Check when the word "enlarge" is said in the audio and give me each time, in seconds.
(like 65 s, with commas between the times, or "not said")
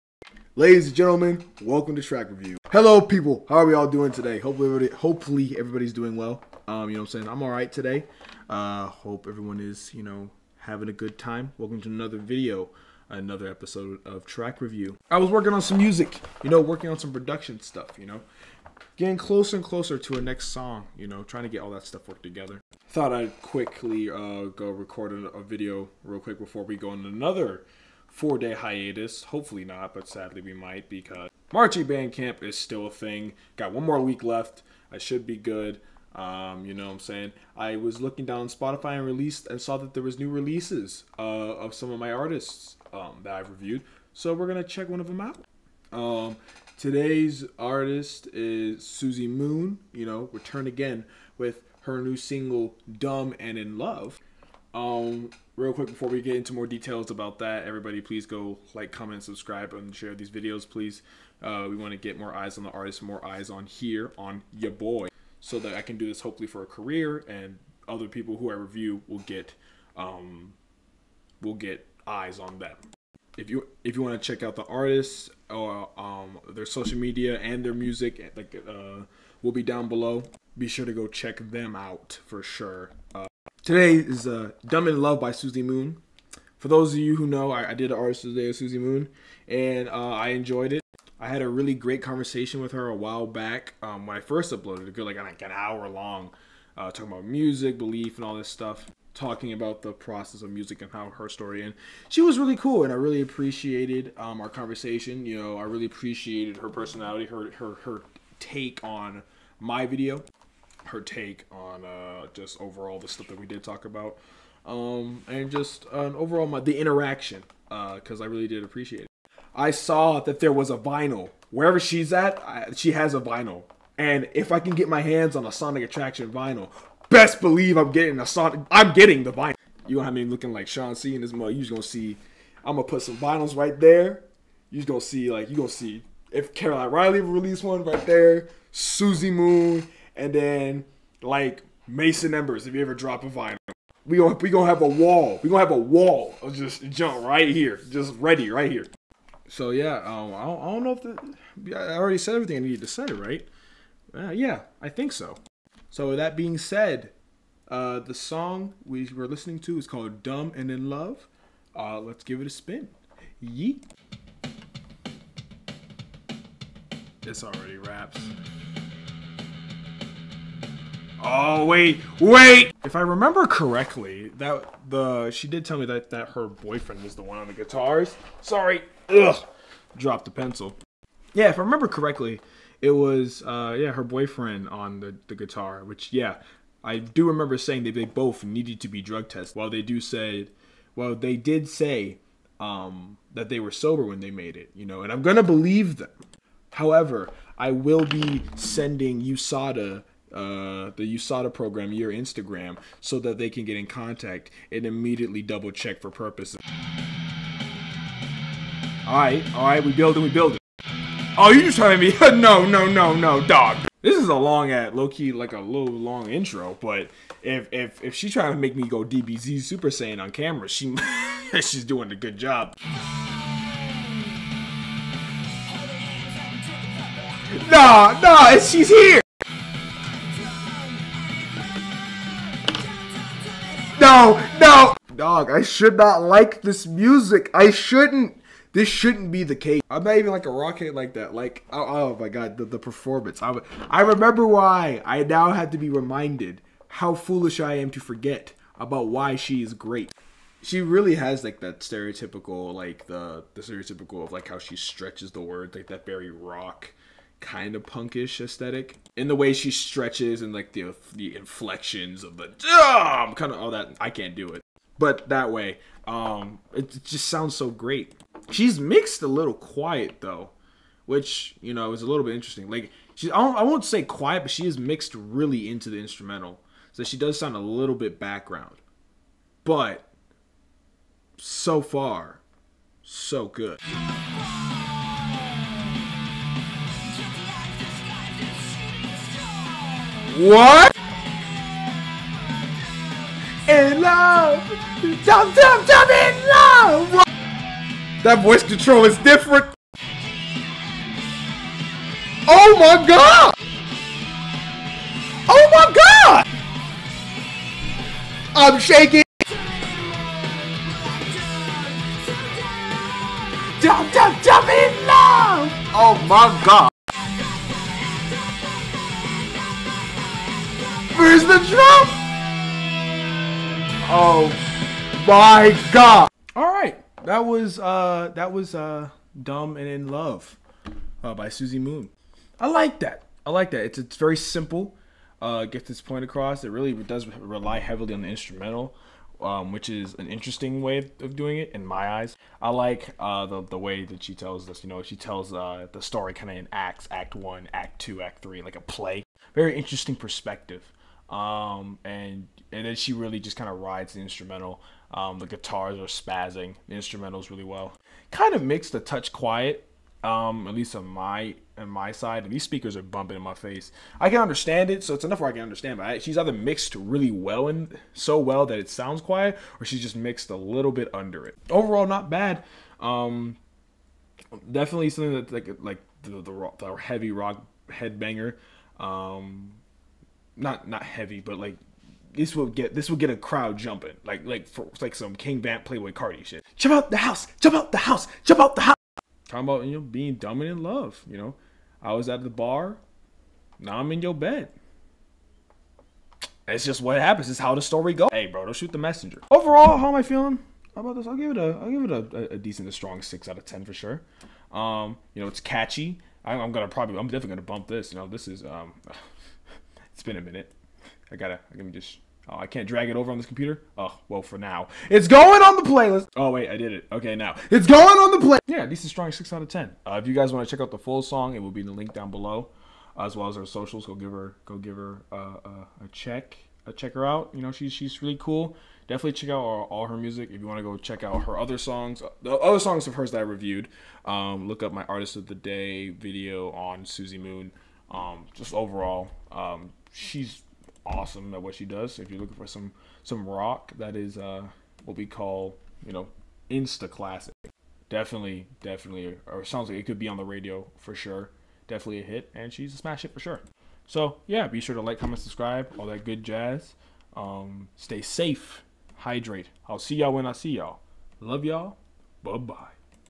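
not said.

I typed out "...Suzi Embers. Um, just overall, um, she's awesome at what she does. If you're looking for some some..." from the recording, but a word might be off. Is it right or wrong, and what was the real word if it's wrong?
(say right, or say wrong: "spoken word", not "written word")
wrong: "Moon", not "Embers".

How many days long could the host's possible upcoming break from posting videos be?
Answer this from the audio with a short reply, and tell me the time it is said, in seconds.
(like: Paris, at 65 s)
4 days, at 28 s.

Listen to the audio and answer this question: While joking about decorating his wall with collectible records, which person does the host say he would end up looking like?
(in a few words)
Sean C.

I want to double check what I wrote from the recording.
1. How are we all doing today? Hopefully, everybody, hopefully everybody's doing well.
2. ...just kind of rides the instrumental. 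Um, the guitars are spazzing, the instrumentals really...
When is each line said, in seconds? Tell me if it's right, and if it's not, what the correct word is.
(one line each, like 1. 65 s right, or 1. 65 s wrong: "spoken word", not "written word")
1. 3 s right
2. 353 s right.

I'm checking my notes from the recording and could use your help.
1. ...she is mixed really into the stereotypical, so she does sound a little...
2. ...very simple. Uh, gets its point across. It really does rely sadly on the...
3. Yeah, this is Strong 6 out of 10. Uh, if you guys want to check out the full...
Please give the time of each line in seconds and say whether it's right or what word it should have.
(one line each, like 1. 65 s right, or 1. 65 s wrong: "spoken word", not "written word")
1. 274 s wrong: "instrumental", not "stereotypical"
2. 334 s wrong: "heavily", not "sadly"
3. 418 s right.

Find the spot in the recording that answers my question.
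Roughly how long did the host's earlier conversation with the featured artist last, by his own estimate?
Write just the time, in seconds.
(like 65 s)
95 s.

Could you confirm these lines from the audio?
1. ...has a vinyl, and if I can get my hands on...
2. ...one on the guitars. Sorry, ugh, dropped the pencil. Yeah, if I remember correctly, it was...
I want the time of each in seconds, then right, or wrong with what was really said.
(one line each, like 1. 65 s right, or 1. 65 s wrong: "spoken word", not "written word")
1. 122 s right
2. 177 s right.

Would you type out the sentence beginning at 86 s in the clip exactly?
For those of you who know, I, I did an artist today with Suzi Moon, and uh, I enjoyed it.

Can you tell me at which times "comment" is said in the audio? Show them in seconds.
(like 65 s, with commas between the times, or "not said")
58 s, 455 s.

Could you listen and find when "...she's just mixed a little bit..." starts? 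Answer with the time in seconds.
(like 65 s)
369 s.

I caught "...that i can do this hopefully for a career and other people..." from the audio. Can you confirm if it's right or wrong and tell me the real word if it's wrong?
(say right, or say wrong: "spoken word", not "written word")
right.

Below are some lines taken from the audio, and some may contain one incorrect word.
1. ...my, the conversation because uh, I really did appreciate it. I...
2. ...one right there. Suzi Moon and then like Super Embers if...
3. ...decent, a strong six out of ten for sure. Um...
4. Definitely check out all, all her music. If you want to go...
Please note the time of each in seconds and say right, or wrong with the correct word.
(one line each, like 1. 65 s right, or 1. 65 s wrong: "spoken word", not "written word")
1. 116 s wrong: "interaction", not "conversation"
2. 137 s wrong: "Mason", not "Super"
3. 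402 s right
4. 429 s right.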